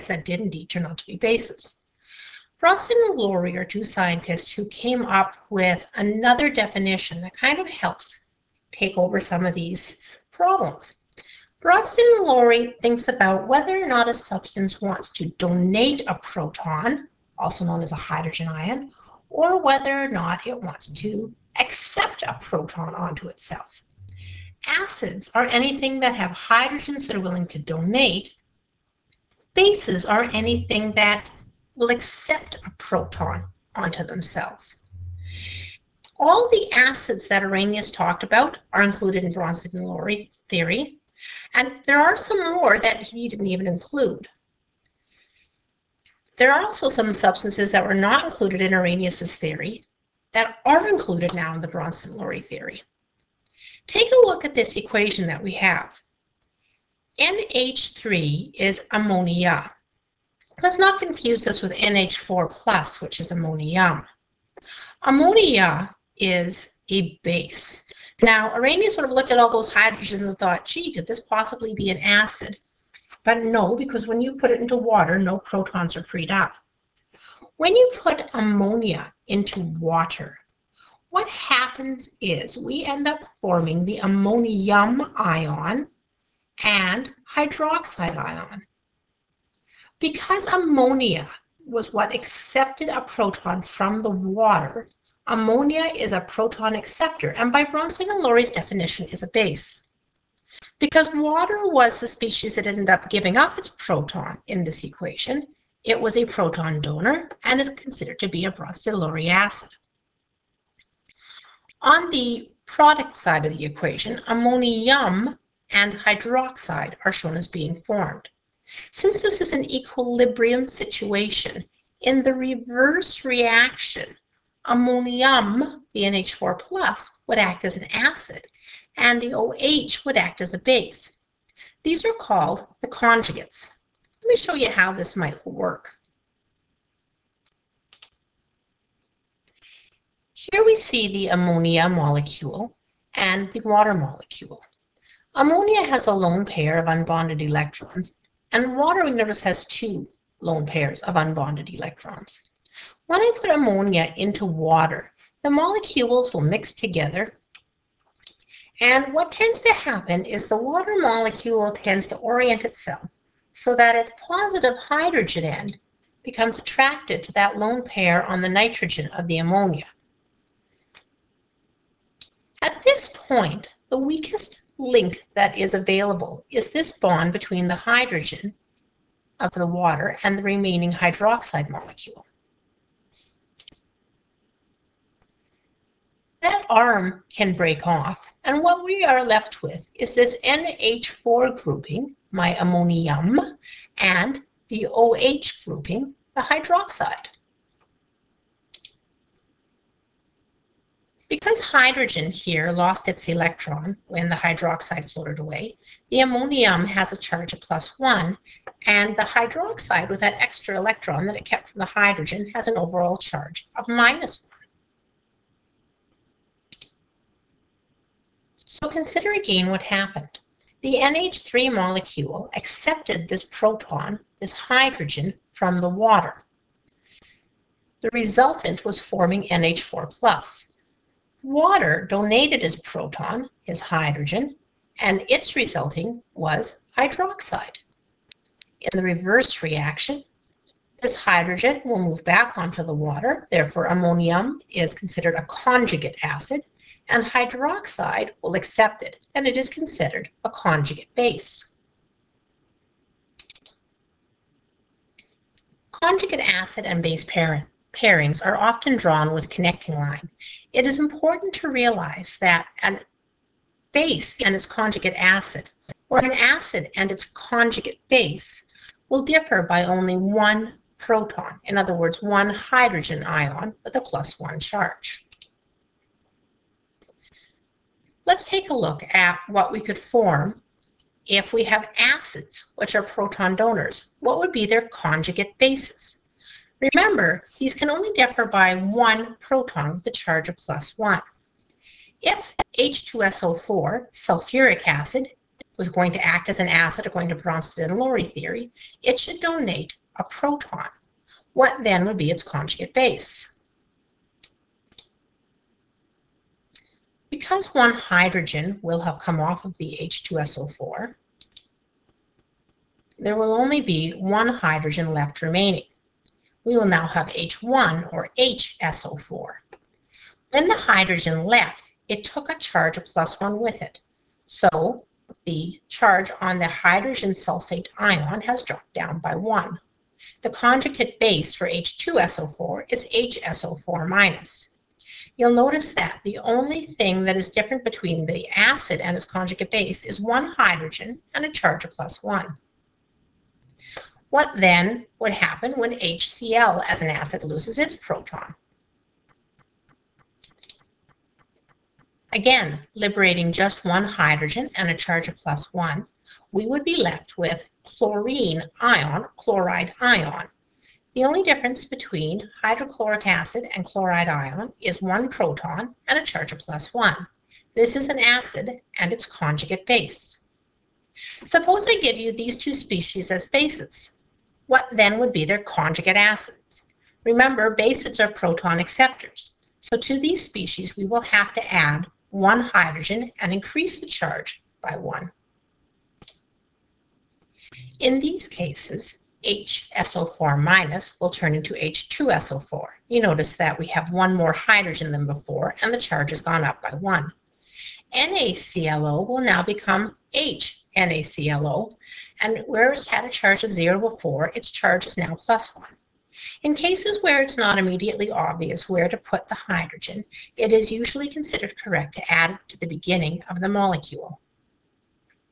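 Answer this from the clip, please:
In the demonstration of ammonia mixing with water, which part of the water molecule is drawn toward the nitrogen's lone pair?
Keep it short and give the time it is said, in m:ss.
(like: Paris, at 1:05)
positive hydrogen end, at 2:44.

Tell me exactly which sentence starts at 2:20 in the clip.
Here we see the ammonia molecule and the water molecule.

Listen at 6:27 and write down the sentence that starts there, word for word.
In these cases, HSO4 minus will turn into H2SO4.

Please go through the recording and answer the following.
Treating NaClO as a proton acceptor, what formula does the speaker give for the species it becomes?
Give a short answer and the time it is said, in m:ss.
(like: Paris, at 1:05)
HNaClO, at 6:40.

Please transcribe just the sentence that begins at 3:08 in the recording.
And what we are left with is this NH4 grouping, my ammonium, and the OH grouping, the hydroxide.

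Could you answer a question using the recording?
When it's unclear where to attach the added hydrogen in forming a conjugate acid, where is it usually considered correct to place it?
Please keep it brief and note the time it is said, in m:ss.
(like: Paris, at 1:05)
beginning of the molecule, at 6:52.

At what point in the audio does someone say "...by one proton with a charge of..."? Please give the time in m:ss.
4:48.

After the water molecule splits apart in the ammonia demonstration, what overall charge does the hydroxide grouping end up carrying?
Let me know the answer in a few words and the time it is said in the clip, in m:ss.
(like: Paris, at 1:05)
minus one, at 3:33.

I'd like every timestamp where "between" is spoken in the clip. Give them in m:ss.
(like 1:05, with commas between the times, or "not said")
2:57, 5:37, 6:01.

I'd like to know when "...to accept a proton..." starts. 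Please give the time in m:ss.
0:20.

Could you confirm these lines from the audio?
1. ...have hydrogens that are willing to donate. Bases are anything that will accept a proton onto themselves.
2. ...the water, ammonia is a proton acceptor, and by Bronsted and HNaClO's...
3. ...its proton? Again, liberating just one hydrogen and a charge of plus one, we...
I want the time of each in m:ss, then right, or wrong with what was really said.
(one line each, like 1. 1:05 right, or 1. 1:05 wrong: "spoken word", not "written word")
1. 0:26 right
2. 1:34 wrong: "Lowry", not "HNaClO"
3. 5:47 right.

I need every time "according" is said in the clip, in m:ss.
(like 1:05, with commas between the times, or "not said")
4:57.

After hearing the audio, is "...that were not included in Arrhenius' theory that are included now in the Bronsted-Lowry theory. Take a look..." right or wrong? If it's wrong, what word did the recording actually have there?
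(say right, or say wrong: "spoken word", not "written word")
right.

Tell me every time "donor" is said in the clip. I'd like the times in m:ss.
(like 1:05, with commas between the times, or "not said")
1:46, 4:43.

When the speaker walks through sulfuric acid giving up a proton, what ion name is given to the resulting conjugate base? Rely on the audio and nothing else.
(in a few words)
hydrogen sulfate ion.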